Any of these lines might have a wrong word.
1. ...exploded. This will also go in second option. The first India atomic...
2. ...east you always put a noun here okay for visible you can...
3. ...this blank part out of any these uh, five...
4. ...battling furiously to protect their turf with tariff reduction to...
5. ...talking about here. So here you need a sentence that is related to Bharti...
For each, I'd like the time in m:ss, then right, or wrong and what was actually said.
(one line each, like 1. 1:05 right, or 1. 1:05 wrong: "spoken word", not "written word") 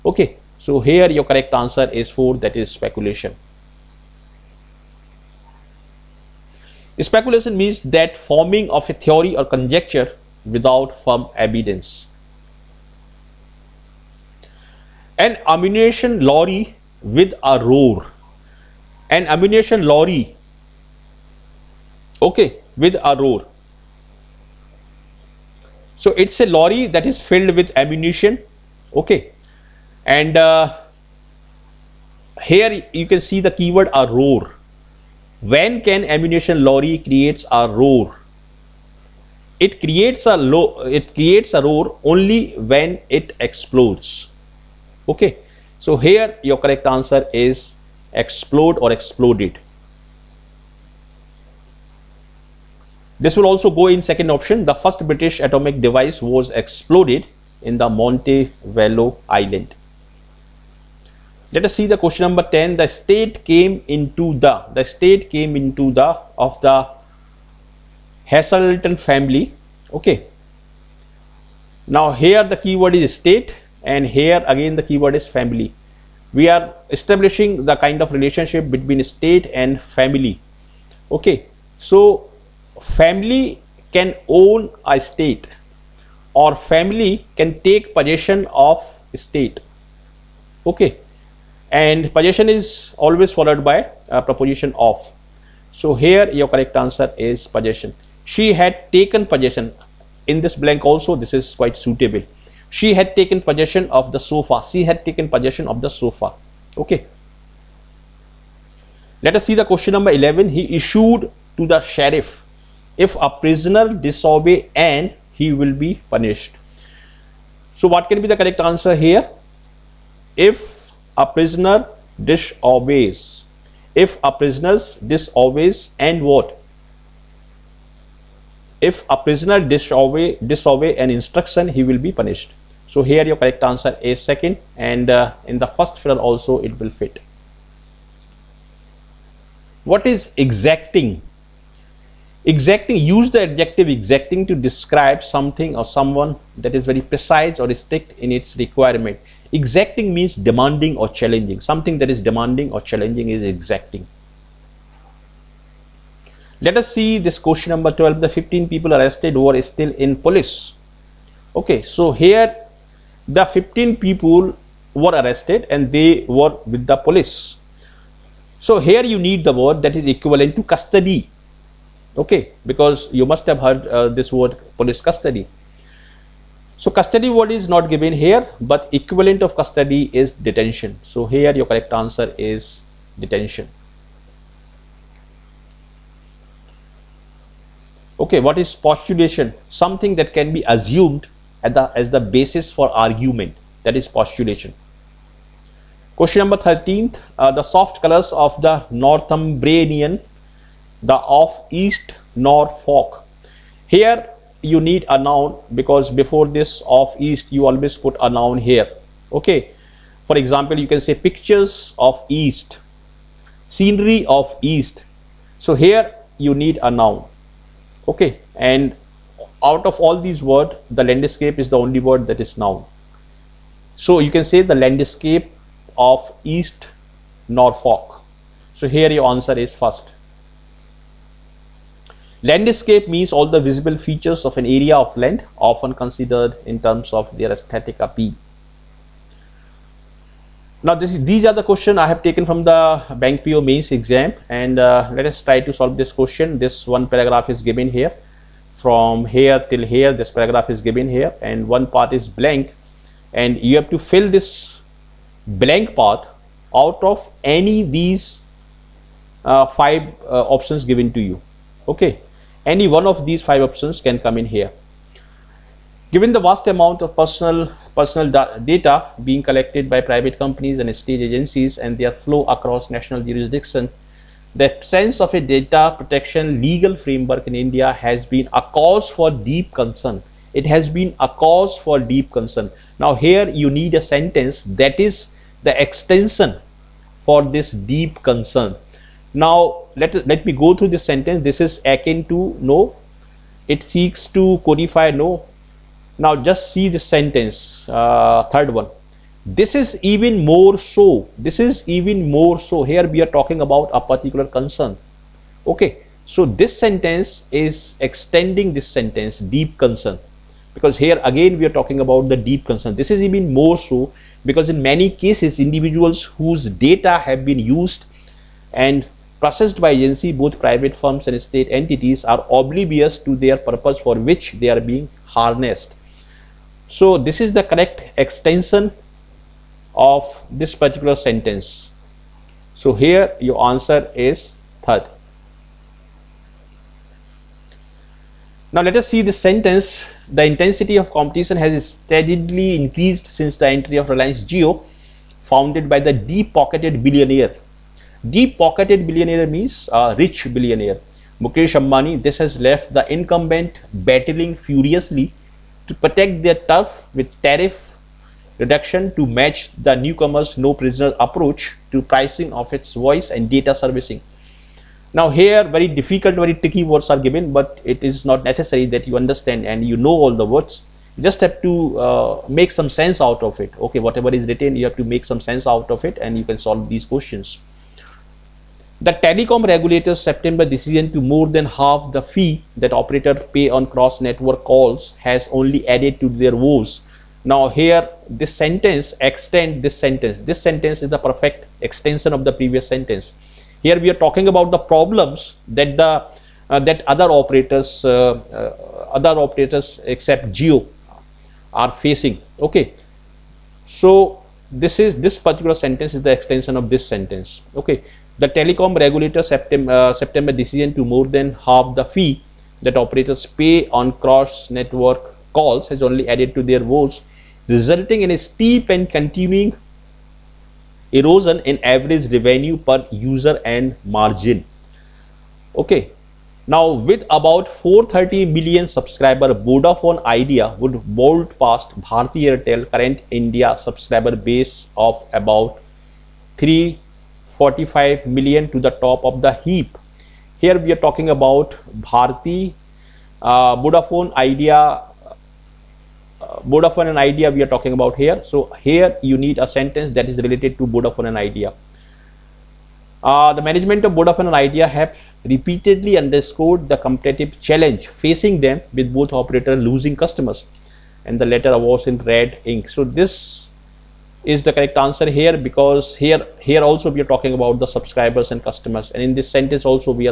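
1. 0:48 wrong: "British", not "India"
2. 3:27 wrong: "example", not "visible"
3. 4:14 right
4. 5:53 right
5. 7:27 wrong: "Vodafone", not "Bharti".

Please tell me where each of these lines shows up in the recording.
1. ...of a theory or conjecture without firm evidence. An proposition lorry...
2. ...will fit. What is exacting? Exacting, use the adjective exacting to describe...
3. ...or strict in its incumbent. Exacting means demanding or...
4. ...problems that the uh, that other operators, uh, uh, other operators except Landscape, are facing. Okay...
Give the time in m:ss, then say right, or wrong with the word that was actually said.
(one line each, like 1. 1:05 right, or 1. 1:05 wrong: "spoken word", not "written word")
1. 0:08 wrong: "ammunition", not "proposition"
2. 2:16 right
3. 2:27 wrong: "requirement", not "incumbent"
4. 6:34 wrong: "Jio", not "Landscape".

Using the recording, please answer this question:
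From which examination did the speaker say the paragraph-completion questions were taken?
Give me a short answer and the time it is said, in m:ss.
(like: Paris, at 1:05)
Bank PO mains, at 4:03.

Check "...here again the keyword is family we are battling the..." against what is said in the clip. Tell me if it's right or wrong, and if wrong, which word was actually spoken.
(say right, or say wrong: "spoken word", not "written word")
wrong: "establishing", not "battling".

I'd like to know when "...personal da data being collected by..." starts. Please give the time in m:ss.
4:27.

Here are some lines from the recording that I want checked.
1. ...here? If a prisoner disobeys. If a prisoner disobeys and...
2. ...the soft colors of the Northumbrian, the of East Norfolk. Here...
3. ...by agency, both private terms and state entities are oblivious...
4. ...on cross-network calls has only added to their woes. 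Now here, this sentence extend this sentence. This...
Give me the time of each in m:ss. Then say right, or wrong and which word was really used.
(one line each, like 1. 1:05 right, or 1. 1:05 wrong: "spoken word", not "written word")
1. 1:58 right
2. 3:17 right
3. 5:19 wrong: "firms", not "terms"
4. 6:23 right.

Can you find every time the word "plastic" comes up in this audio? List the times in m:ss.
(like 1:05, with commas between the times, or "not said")
not said.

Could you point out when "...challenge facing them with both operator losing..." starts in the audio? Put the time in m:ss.
7:37.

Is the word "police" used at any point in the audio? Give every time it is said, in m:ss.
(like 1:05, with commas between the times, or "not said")
2:40, 2:46, 2:54.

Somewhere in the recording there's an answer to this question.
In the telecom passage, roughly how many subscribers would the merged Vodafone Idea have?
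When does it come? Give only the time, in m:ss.
7:07.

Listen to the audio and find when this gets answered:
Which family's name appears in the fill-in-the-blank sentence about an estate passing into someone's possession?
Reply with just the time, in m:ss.
1:08.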